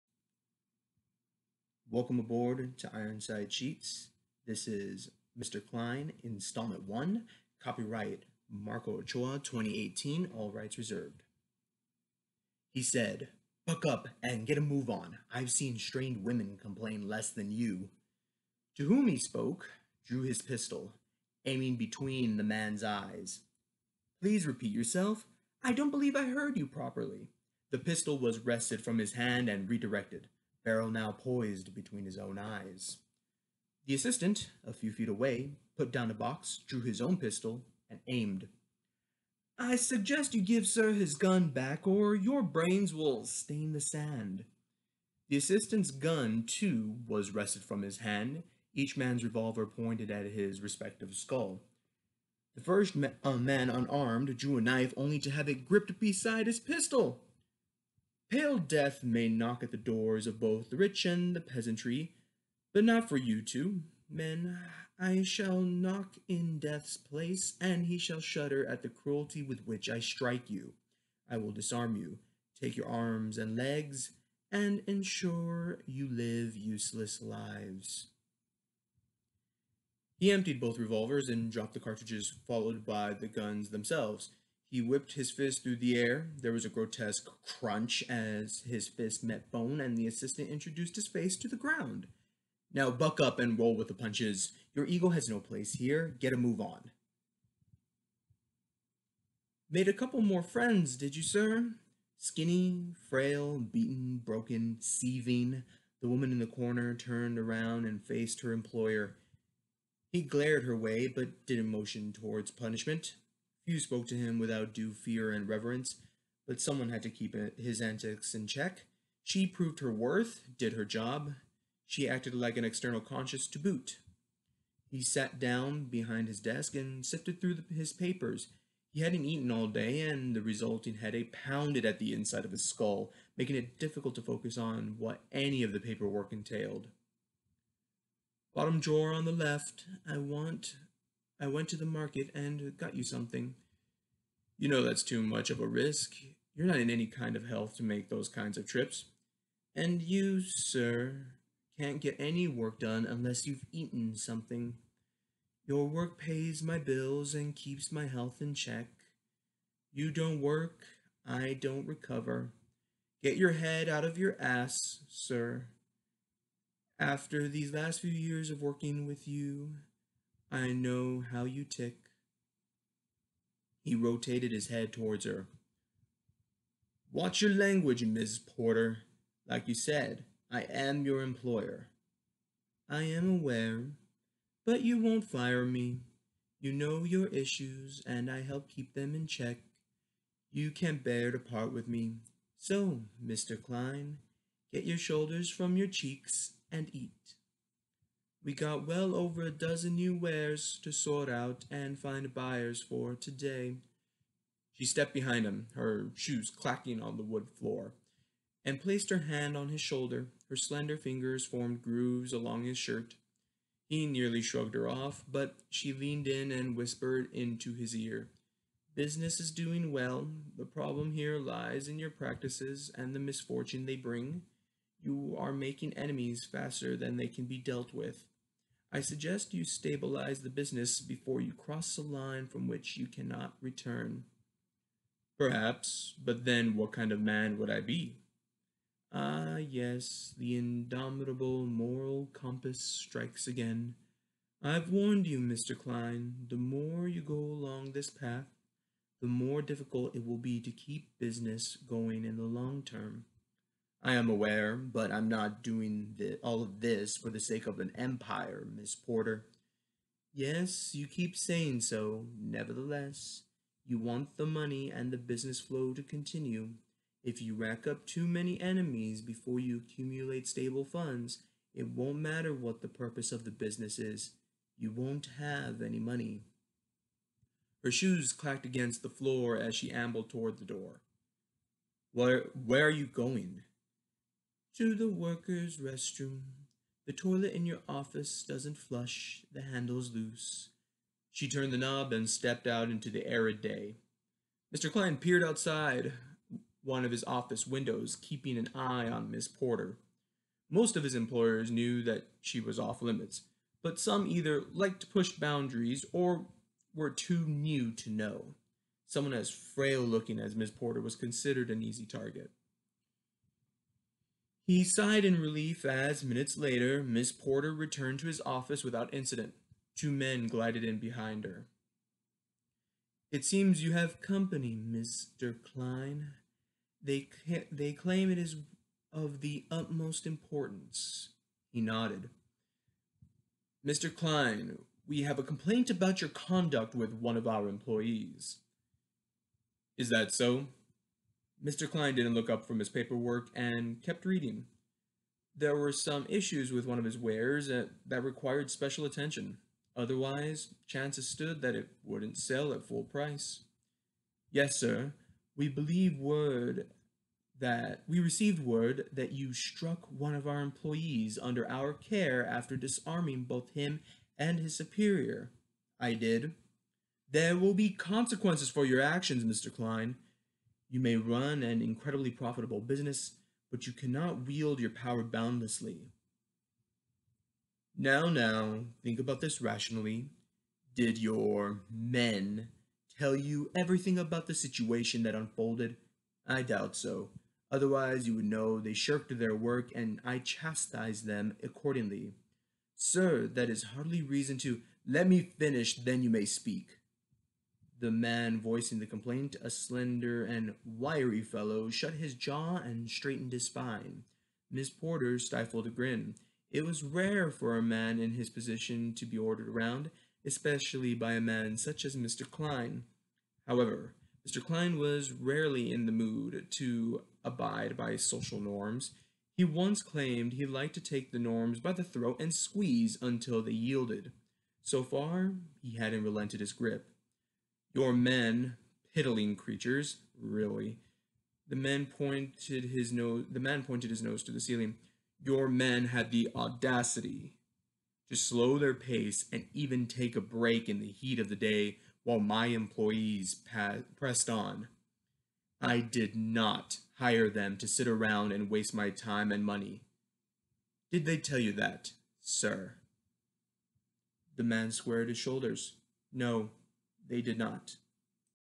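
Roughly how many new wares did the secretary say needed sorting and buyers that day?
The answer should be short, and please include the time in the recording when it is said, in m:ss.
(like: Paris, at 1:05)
over a dozen, at 3:18.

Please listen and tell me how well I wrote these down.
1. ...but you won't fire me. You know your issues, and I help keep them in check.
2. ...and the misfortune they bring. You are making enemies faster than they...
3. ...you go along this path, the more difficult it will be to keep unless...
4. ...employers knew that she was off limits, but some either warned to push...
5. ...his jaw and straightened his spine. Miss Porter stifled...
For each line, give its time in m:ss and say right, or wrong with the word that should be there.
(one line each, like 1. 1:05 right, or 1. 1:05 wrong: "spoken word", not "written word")
1. 3:04 right
2. 3:42 right
3. 4:07 wrong: "business", not "unless"
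4. 5:01 wrong: "liked", not "warned"
5. 6:42 right.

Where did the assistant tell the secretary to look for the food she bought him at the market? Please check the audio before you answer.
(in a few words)
Bottom drawer on the left.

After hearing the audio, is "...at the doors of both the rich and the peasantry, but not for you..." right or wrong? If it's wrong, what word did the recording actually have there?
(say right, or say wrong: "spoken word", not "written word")
right.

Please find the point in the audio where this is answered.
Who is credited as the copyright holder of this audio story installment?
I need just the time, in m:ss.
0:08.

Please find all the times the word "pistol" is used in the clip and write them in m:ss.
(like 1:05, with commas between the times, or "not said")
0:20, 0:27, 0:37, 0:56.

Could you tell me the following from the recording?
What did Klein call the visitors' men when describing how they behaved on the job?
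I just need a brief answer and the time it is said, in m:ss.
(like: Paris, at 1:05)
piddling creatures, at 7:09.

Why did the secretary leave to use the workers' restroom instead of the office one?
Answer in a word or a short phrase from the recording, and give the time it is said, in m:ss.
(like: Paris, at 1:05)
handle's loose, at 4:49.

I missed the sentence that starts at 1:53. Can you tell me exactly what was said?
Few spoke to him without due fear and reverence, but someone had to keep his antics in check.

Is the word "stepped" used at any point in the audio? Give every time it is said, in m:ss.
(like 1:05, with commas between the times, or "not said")
3:24, 4:52.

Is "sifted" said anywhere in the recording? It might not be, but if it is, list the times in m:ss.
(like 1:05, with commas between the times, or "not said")
2:07.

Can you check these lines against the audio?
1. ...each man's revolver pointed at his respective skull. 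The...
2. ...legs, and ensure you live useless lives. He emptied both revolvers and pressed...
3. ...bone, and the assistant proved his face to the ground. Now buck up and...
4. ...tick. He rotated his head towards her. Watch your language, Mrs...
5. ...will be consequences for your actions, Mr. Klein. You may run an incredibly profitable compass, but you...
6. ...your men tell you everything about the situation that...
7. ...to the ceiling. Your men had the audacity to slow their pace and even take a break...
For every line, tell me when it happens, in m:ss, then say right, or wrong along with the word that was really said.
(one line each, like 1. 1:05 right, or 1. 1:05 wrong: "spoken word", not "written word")
1. 0:48 right
2. 1:13 wrong: "dropped", not "pressed"
3. 1:29 wrong: "introduced", not "proved"
4. 2:51 right
5. 6:07 wrong: "business", not "compass"
6. 6:21 right
7. 7:14 right.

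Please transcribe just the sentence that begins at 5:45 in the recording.
There were some issues with one of his wares uh, that required special attention.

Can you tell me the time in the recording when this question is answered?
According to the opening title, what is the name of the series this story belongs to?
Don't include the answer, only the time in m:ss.
0:02.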